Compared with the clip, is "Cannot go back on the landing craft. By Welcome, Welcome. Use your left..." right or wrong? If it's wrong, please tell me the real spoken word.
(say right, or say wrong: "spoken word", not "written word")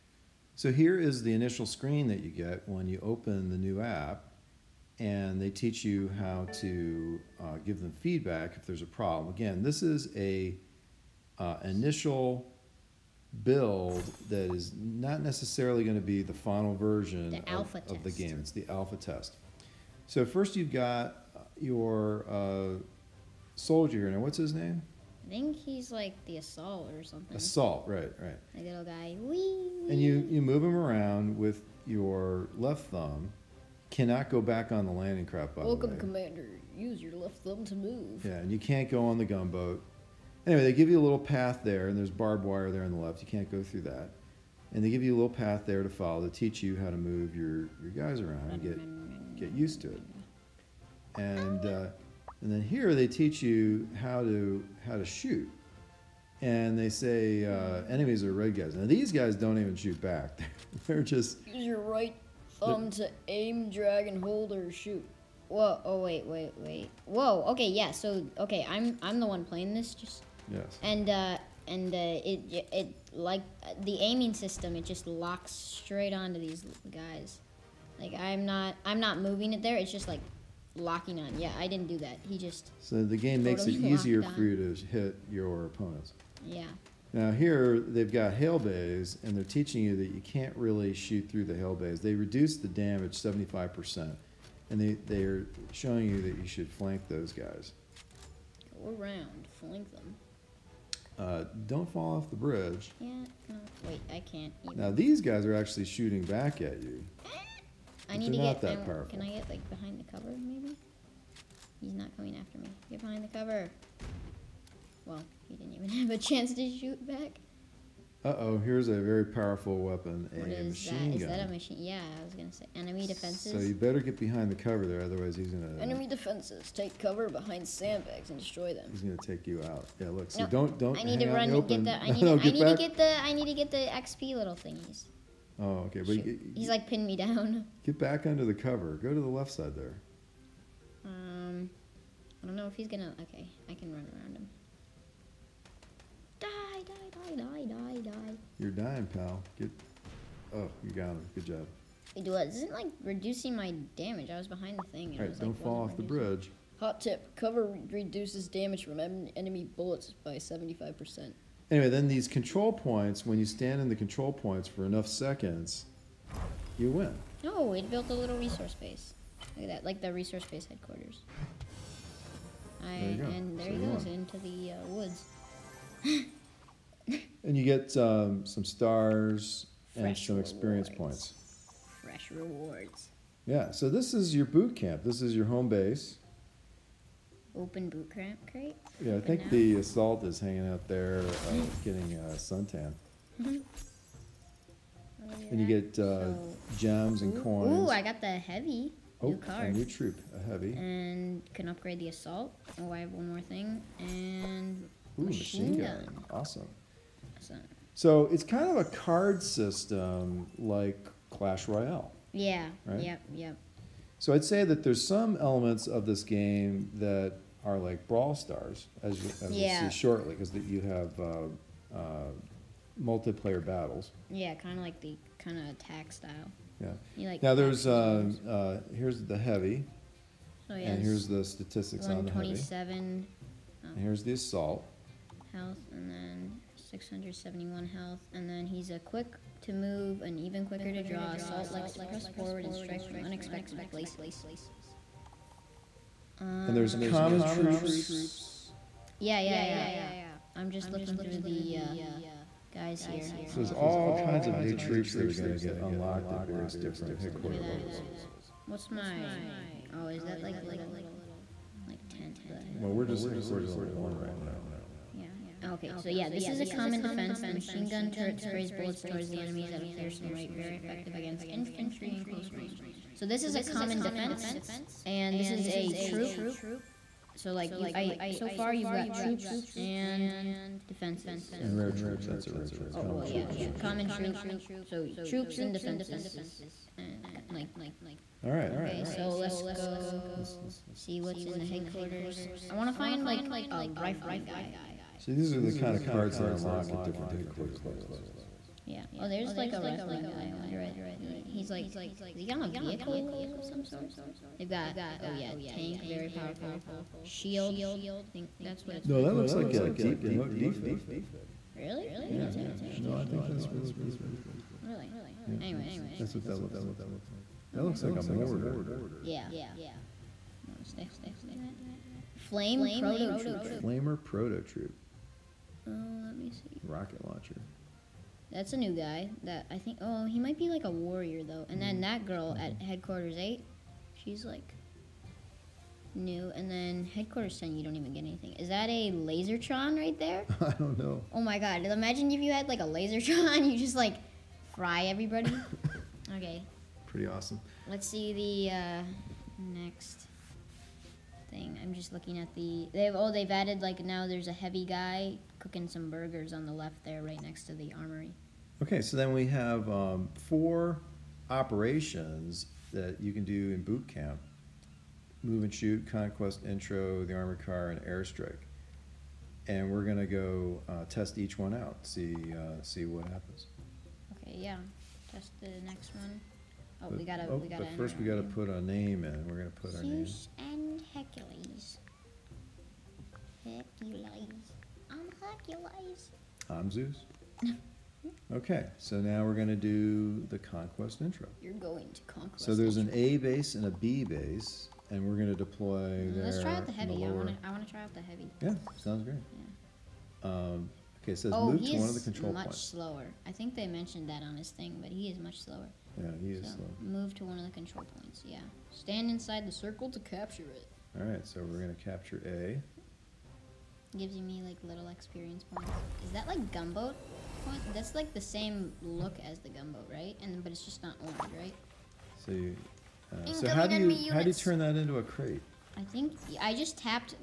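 wrong: "Commander", not "Welcome".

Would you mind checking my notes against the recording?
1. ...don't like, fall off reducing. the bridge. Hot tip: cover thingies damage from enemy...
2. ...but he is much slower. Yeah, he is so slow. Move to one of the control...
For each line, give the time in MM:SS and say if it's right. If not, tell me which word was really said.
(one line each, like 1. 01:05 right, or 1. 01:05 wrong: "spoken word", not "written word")
1. 02:35 wrong: "reduces", not "thingies"
2. 06:45 right.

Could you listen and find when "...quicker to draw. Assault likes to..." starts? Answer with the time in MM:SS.
04:00.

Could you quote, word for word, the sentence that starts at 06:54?
Gives me like little experience points.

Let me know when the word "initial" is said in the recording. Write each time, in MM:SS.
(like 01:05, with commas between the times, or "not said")
00:01, 00:11.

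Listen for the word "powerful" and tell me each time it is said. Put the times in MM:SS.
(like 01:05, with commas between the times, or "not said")
01:59, 05:06.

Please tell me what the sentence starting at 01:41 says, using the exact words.
Uh, don't fall off the bridge.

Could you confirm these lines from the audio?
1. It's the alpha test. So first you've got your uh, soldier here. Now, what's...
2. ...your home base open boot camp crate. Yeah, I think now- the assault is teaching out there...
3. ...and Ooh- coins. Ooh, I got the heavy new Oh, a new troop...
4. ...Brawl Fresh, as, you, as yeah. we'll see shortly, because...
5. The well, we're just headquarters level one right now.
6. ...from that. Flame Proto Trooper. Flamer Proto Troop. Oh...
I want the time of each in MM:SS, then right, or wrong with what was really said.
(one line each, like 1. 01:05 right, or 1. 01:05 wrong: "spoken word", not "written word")
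1. 00:18 right
2. 03:05 wrong: "hanging", not "teaching"
3. 03:17 right
4. 03:38 wrong: "Stars", not "Fresh"
5. 04:22 right
6. 05:21 right.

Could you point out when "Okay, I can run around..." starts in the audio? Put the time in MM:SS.
02:23.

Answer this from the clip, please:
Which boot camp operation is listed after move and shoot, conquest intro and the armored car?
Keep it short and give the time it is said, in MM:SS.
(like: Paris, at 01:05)
Airstrike, at 06:08.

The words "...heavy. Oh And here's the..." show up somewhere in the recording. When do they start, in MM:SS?
03:49.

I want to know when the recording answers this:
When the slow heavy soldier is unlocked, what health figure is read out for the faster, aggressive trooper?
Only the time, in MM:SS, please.
03:56.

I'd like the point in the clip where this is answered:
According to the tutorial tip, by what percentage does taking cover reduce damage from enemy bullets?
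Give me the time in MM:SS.
01:33.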